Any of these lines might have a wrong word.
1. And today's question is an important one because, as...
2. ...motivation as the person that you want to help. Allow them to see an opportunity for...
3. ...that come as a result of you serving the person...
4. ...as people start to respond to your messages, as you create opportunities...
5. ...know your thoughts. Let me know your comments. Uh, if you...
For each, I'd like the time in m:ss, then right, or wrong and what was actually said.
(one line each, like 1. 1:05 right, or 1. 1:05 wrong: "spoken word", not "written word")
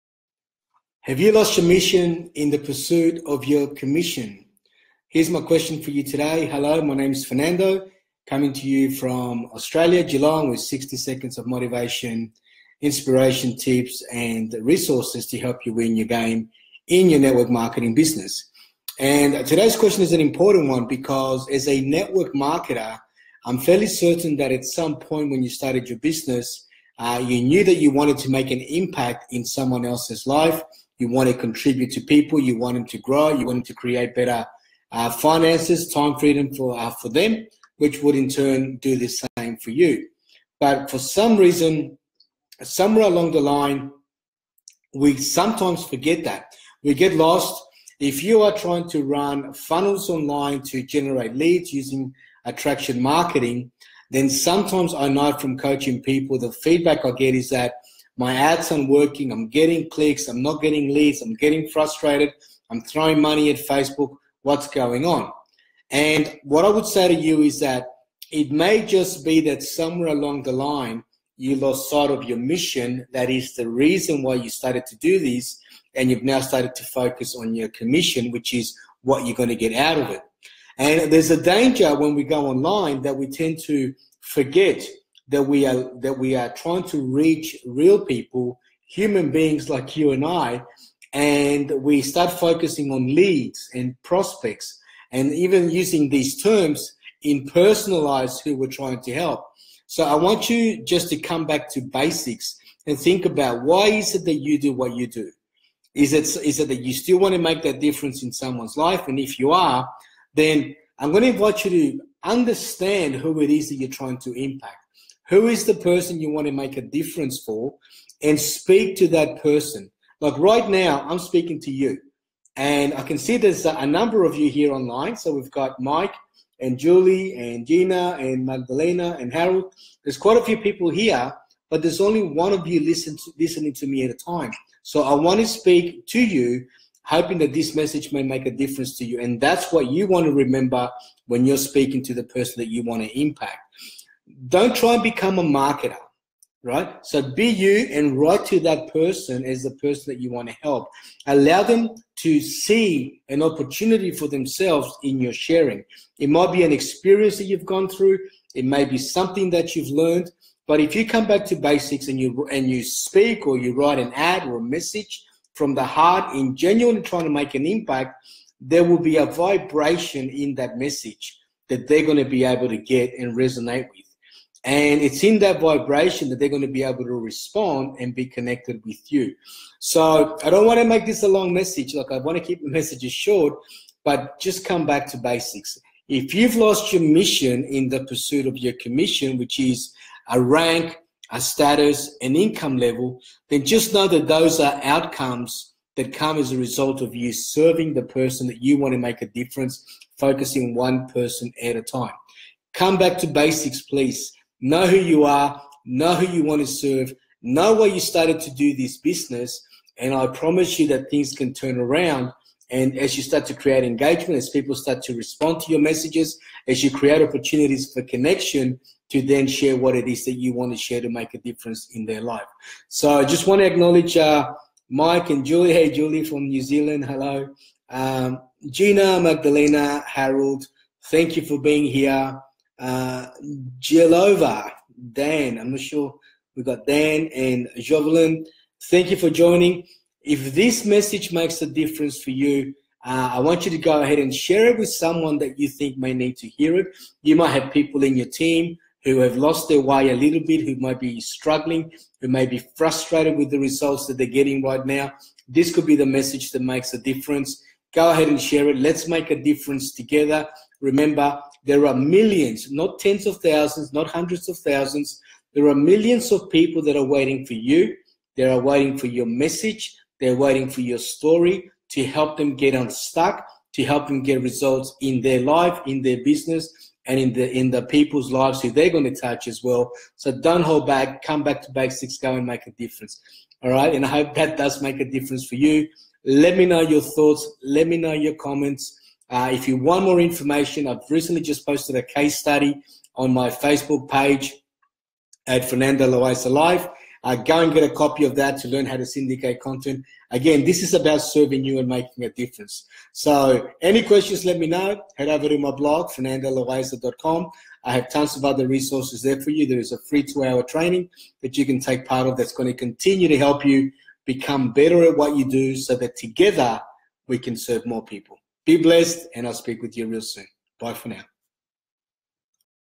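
1. 0:18 right
2. 2:28 wrong: "person", not "motivation"
3. 3:15 right
4. 3:34 right
5. 4:46 right.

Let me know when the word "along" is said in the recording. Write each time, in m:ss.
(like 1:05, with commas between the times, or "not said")
0:43, 1:10.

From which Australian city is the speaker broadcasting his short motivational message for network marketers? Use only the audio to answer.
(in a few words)
Geelong.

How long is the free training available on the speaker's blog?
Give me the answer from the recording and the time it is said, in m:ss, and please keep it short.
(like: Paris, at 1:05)
2 hours, at 5:10.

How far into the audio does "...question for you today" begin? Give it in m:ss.
0:05.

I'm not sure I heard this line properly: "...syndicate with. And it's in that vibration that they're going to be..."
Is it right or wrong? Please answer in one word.
wrong.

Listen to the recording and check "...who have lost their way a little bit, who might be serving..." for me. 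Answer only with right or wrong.
wrong.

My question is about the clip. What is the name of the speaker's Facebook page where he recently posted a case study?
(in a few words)
Fernando Loaiza Live.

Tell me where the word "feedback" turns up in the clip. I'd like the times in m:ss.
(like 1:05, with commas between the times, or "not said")
0:56.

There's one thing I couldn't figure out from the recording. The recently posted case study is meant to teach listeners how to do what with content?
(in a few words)
syndicate.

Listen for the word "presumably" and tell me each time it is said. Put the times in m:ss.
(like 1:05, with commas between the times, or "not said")
not said.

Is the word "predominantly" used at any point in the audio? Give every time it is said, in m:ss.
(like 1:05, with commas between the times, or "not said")
not said.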